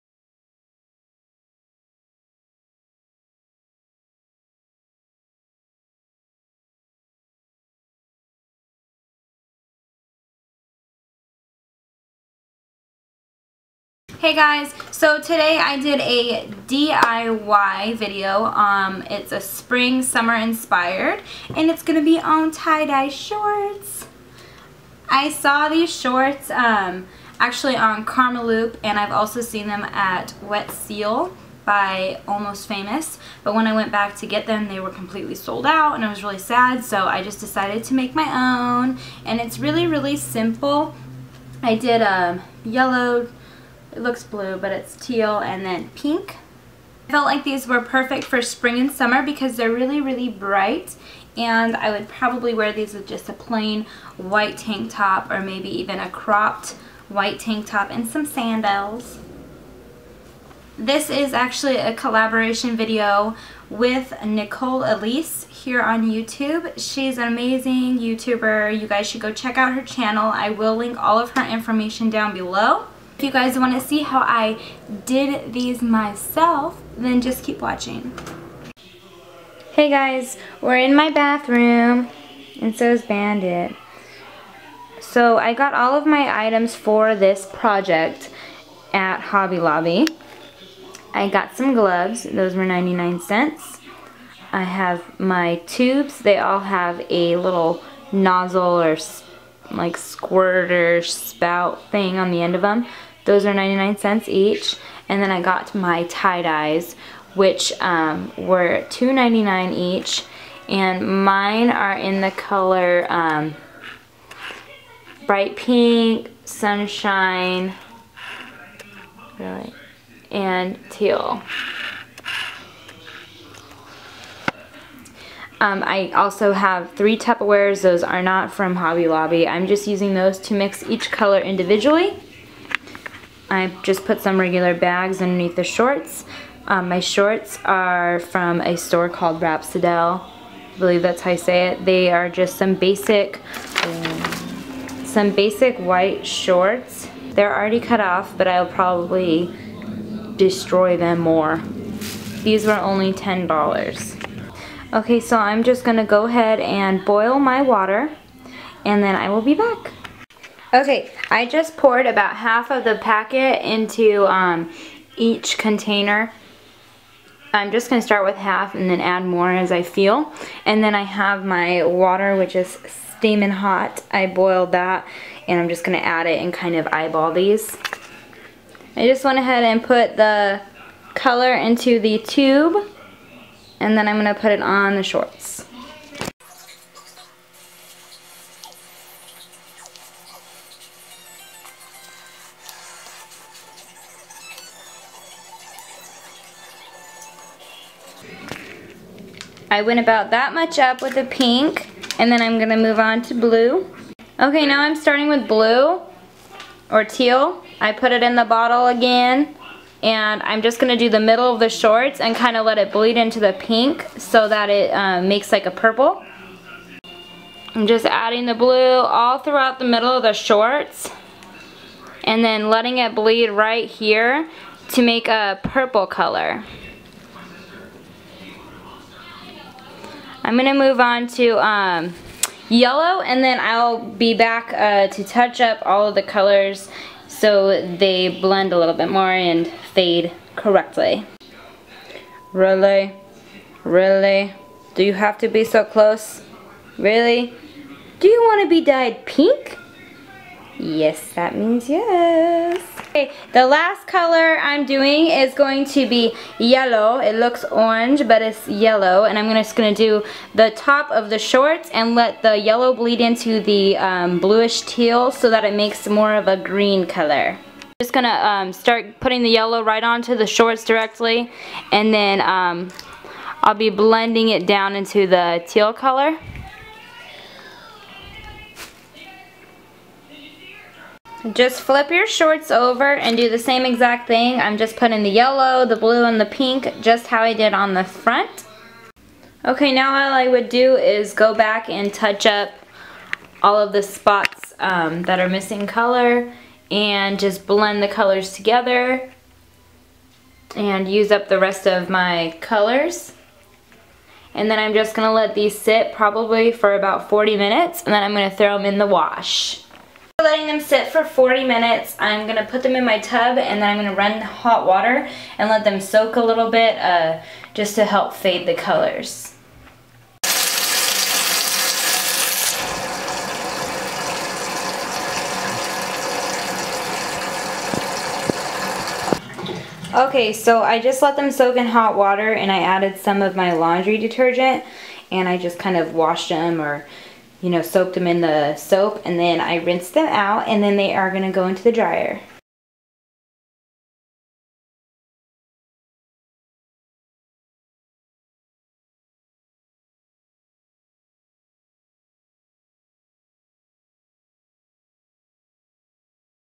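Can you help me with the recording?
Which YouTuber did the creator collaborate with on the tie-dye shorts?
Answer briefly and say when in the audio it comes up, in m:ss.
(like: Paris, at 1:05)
Nicole Elise, at 1:04.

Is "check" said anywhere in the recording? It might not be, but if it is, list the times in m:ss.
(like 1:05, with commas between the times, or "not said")
1:09.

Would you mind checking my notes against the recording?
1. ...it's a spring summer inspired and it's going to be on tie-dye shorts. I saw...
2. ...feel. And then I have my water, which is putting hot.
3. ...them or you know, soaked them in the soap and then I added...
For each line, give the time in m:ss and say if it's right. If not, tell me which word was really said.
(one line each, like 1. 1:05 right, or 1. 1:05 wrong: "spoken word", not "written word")
1. 0:19 right
2. 2:49 wrong: "steaming", not "putting"
3. 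5:36 wrong: "rinsed", not "added".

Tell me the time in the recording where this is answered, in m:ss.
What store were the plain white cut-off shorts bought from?
2:19.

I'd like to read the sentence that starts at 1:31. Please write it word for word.
I got some gloves, those were 99 cents.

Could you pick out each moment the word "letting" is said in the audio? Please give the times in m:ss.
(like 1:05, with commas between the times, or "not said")
3:42, 5:10.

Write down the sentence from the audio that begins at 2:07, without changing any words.
Those are not from Hobby Lobby.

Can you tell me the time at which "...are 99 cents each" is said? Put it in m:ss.
1:43.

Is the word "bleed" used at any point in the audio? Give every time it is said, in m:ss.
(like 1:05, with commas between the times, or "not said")
3:32, 3:43, 4:22.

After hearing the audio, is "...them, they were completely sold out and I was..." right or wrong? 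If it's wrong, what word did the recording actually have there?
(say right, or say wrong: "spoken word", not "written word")
right.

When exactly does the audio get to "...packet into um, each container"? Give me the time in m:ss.
2:43.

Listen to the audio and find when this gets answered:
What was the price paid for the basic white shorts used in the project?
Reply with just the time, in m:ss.
2:33.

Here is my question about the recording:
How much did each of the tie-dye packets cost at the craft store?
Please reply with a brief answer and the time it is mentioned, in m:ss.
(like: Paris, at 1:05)
$2.99, at 1:48.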